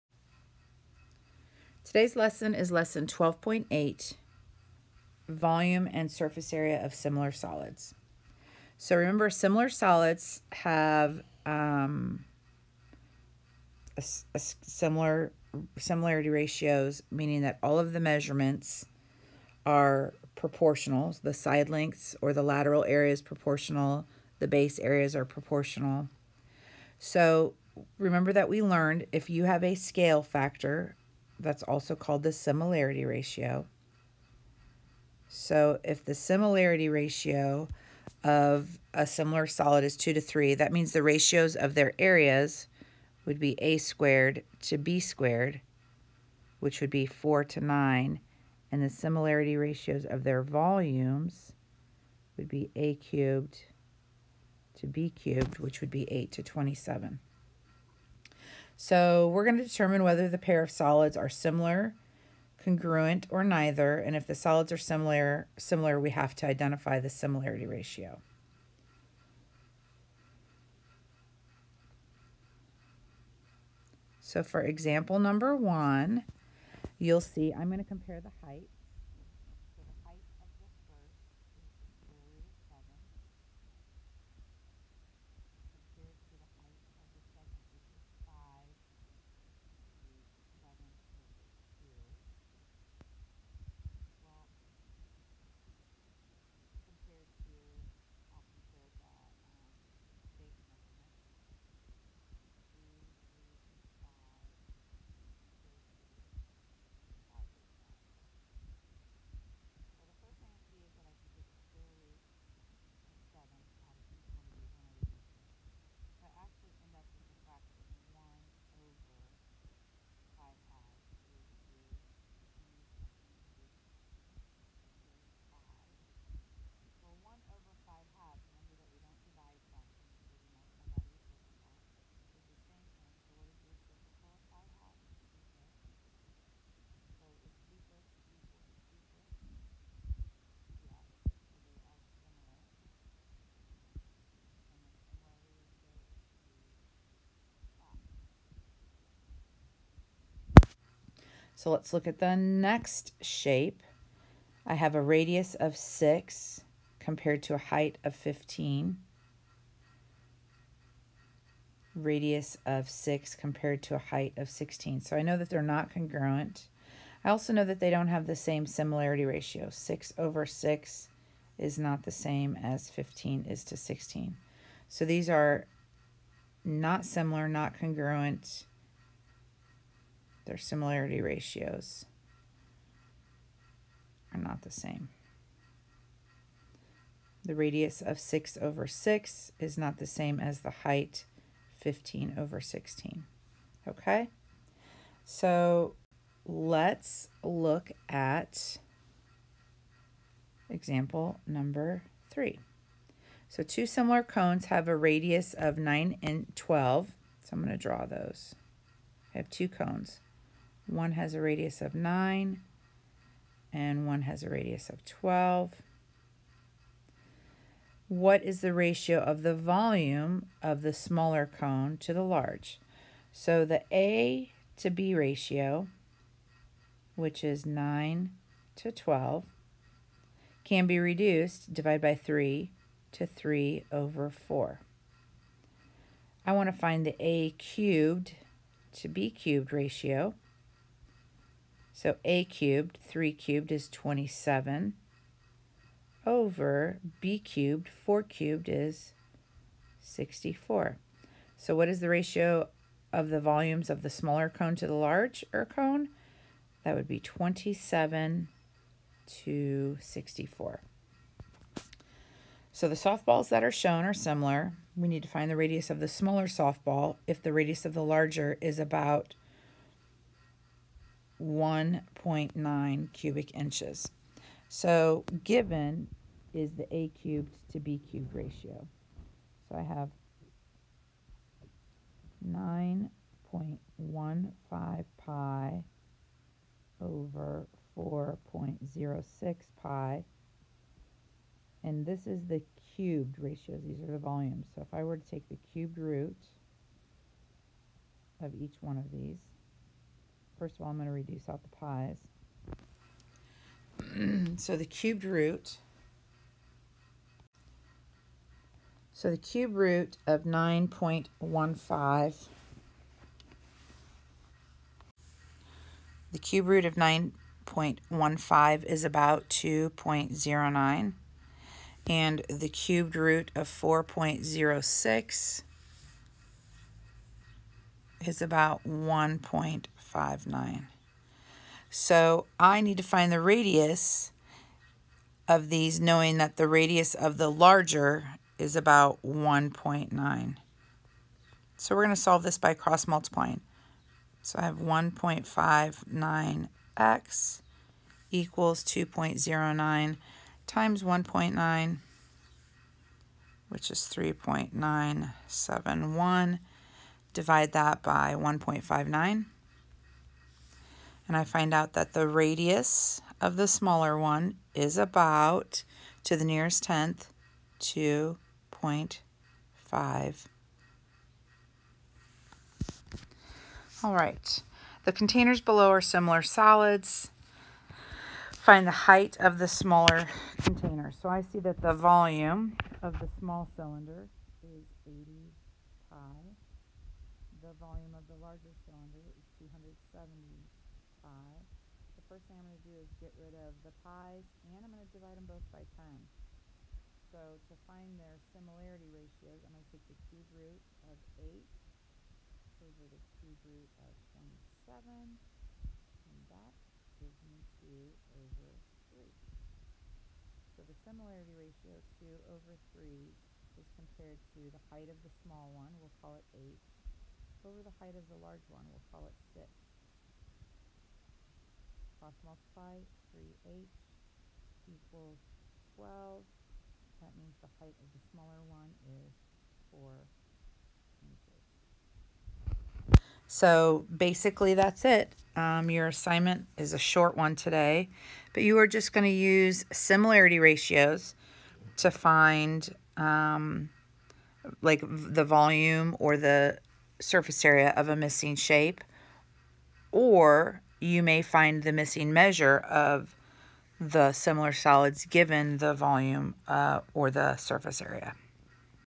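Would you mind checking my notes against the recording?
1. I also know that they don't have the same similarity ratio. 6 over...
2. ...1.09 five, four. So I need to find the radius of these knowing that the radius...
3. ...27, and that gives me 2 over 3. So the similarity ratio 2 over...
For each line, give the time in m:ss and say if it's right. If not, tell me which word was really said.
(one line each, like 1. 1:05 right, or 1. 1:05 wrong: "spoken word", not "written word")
1. 2:47 right
2. 5:28 wrong: "nine", not "four"
3. 6:44 right.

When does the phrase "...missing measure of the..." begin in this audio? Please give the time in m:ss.
7:31.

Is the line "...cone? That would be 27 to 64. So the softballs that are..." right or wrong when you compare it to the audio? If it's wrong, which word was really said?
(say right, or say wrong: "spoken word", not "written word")
right.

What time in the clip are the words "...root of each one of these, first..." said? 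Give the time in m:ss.
4:55.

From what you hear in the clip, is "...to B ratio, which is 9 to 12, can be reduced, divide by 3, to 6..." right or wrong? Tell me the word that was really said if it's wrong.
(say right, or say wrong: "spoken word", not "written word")
wrong: "3", not "6".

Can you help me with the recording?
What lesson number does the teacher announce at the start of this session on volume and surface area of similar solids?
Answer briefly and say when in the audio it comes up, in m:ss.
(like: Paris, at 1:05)
12.8, at 0:02.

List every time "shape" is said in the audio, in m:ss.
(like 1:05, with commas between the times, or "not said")
2:33, 7:28.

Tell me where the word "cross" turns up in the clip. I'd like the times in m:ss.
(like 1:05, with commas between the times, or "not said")
5:42, 7:02.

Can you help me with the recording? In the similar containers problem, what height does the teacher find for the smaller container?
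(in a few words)
4 inches.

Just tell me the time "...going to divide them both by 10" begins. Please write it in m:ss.
6:34.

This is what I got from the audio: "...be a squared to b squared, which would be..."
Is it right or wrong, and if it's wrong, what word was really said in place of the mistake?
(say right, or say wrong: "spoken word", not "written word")
right.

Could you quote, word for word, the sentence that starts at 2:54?
So these are not similar, not congruent, their similarity ratios are not the same.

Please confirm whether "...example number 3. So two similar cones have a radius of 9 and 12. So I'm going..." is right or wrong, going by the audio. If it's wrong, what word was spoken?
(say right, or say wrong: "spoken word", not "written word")
right.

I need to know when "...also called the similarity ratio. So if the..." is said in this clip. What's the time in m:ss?
0:31.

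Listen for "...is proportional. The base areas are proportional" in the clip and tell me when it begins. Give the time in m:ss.
0:23.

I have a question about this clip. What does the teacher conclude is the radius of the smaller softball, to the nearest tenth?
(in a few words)
2.5.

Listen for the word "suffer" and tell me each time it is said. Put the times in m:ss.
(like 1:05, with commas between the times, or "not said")
not said.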